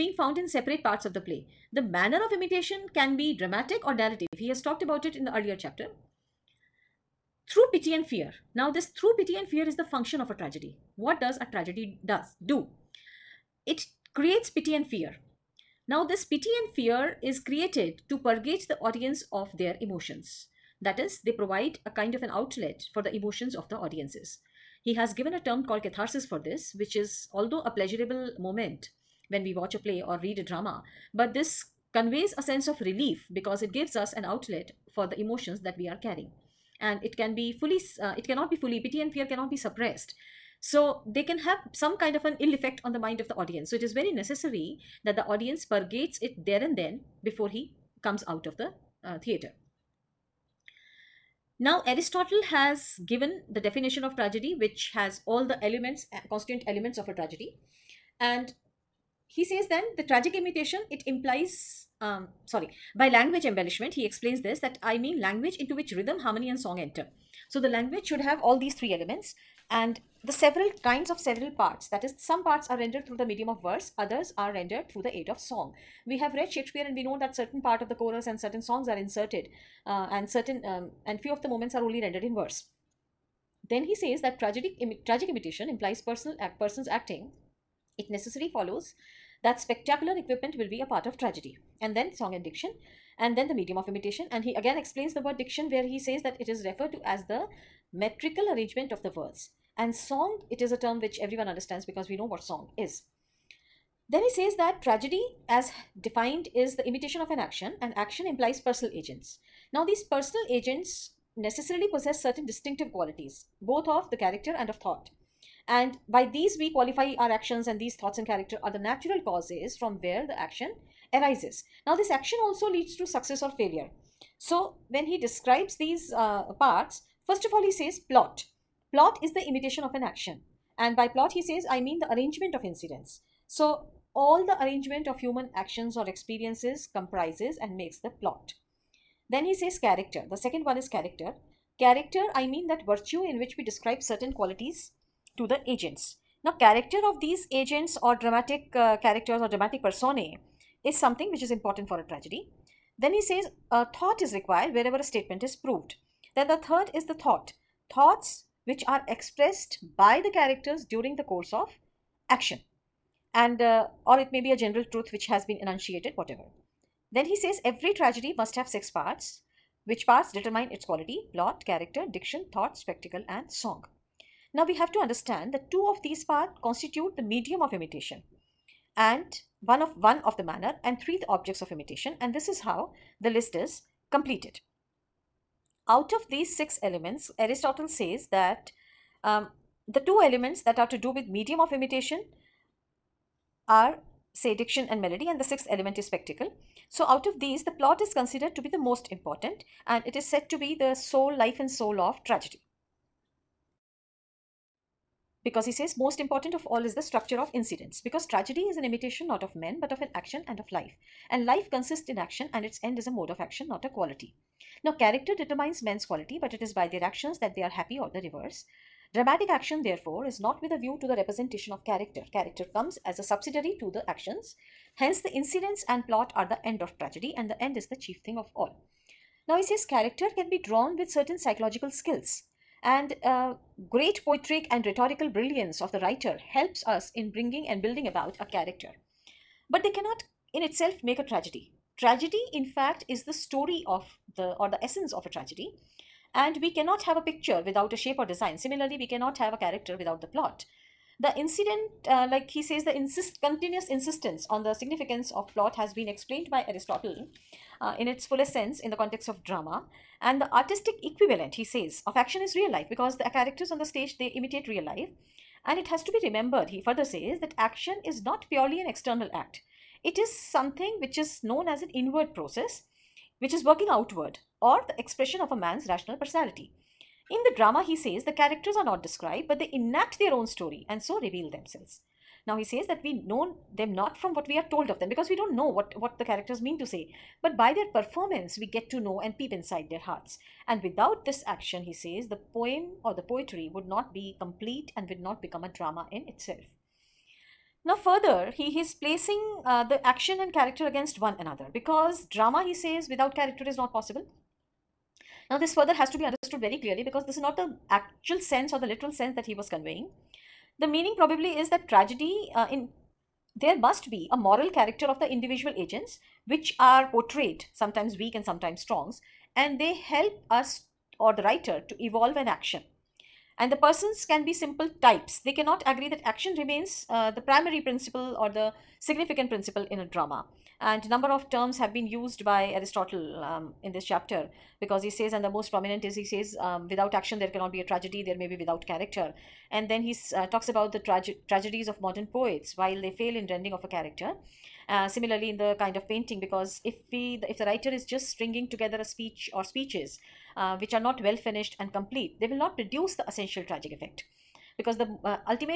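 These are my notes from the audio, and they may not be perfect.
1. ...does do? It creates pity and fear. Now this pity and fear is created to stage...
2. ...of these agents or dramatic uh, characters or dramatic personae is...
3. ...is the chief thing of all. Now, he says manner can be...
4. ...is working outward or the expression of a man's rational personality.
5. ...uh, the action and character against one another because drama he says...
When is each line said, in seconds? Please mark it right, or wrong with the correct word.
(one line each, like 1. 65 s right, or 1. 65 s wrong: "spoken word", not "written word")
1. 12 s wrong: "purge", not "stage"
2. 147 s right
3. 227 s wrong: "character", not "manner"
4. 273 s right
5. 299 s right.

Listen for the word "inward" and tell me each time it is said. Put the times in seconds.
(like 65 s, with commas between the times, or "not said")
271 s.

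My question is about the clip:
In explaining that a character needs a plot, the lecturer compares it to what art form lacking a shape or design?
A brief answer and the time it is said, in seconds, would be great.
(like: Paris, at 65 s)
a picture, at 247 s.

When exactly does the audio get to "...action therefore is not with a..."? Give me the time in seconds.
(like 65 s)
219 s.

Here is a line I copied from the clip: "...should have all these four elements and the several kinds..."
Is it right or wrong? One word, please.
wrong.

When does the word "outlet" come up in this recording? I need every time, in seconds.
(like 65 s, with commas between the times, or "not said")
22 s, 34 s.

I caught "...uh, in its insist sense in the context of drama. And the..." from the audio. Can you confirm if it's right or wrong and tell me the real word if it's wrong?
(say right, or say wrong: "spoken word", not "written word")
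wrong: "fullest", not "insist".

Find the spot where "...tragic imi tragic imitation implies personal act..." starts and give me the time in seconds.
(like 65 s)
84 s.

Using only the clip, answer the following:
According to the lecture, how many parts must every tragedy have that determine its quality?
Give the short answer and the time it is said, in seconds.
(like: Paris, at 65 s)
6, at 168 s.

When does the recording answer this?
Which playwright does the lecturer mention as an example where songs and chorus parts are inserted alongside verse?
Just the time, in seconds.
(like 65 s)
76 s.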